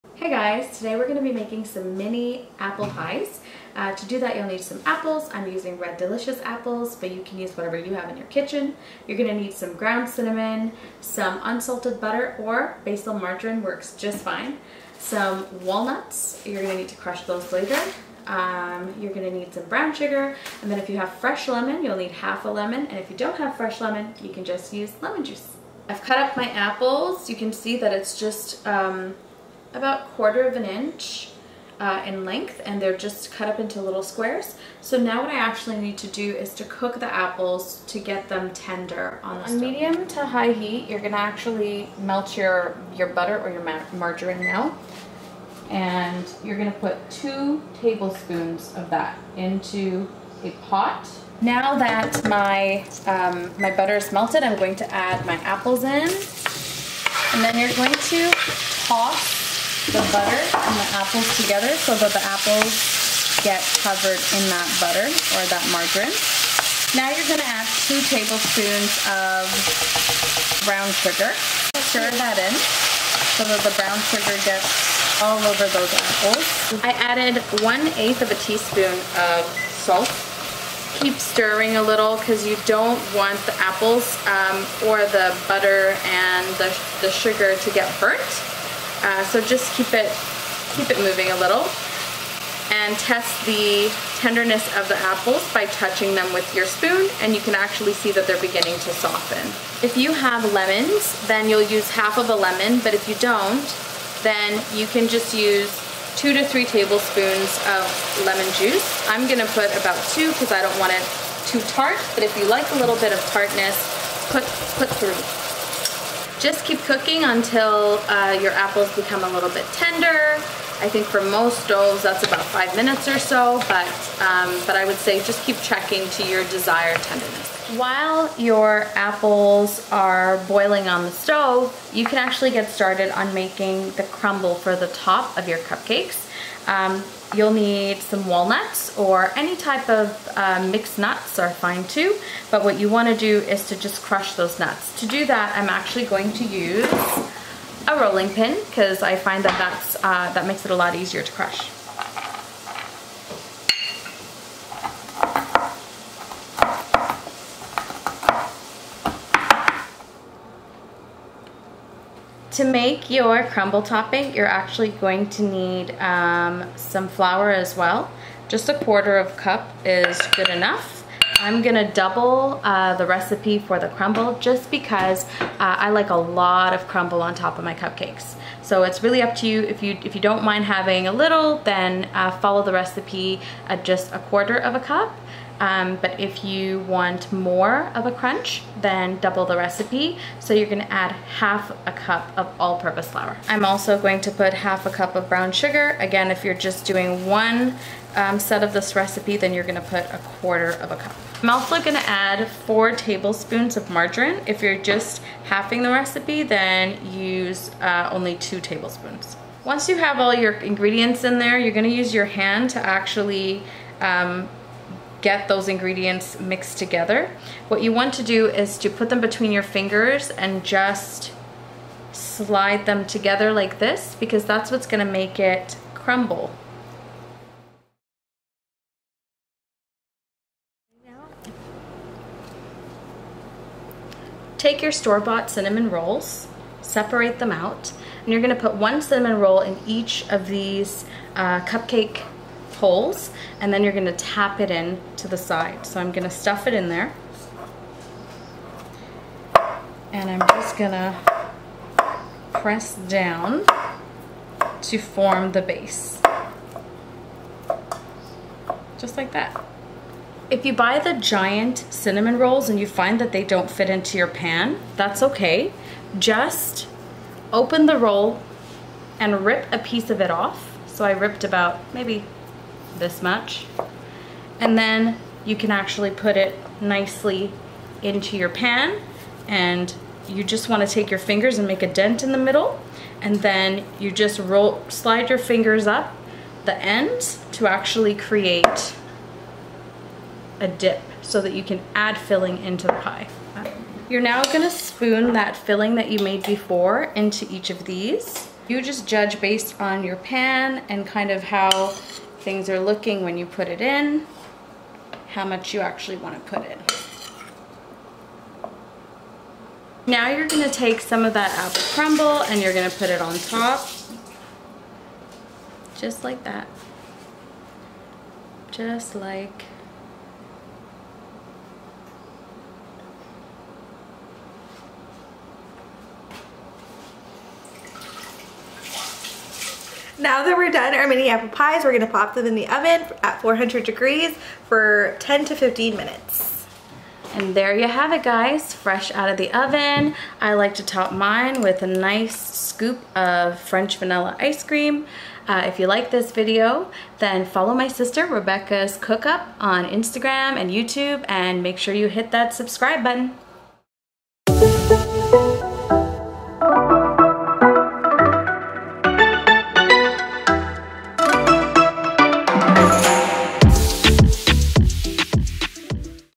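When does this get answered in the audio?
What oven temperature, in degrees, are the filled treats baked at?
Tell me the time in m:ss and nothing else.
5:33.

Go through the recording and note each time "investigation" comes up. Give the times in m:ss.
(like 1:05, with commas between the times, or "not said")
not said.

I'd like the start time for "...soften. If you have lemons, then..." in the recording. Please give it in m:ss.
1:38.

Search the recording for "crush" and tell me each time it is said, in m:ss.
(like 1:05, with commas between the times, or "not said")
0:16, 2:24, 2:31.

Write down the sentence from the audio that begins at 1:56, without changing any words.
Just keep cooking until uh, your apples become a little bit tender.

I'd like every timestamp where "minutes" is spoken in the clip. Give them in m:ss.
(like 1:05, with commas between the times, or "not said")
2:02, 5:35.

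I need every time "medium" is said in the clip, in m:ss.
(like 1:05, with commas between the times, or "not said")
0:39.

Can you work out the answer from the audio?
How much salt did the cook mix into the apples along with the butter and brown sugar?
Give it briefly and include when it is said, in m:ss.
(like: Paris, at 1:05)
1/8 teaspoon, at 1:17.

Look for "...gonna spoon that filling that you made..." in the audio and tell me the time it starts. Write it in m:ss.
4:54.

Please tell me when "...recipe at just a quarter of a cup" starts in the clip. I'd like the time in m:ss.
3:02.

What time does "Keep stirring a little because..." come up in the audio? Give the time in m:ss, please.
1:21.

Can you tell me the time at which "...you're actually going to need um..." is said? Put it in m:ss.
2:44.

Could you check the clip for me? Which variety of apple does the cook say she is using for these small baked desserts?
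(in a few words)
Red Delicious.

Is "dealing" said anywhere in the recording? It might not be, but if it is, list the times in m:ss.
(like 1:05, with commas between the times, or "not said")
not said.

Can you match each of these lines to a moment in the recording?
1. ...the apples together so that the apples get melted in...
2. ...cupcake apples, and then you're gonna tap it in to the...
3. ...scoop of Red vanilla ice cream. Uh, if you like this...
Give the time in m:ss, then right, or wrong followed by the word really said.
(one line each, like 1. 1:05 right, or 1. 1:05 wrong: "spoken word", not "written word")
1. 1:00 wrong: "covered", not "melted"
2. 4:01 wrong: "holes", not "apples"
3. 5:42 wrong: "French", not "Red".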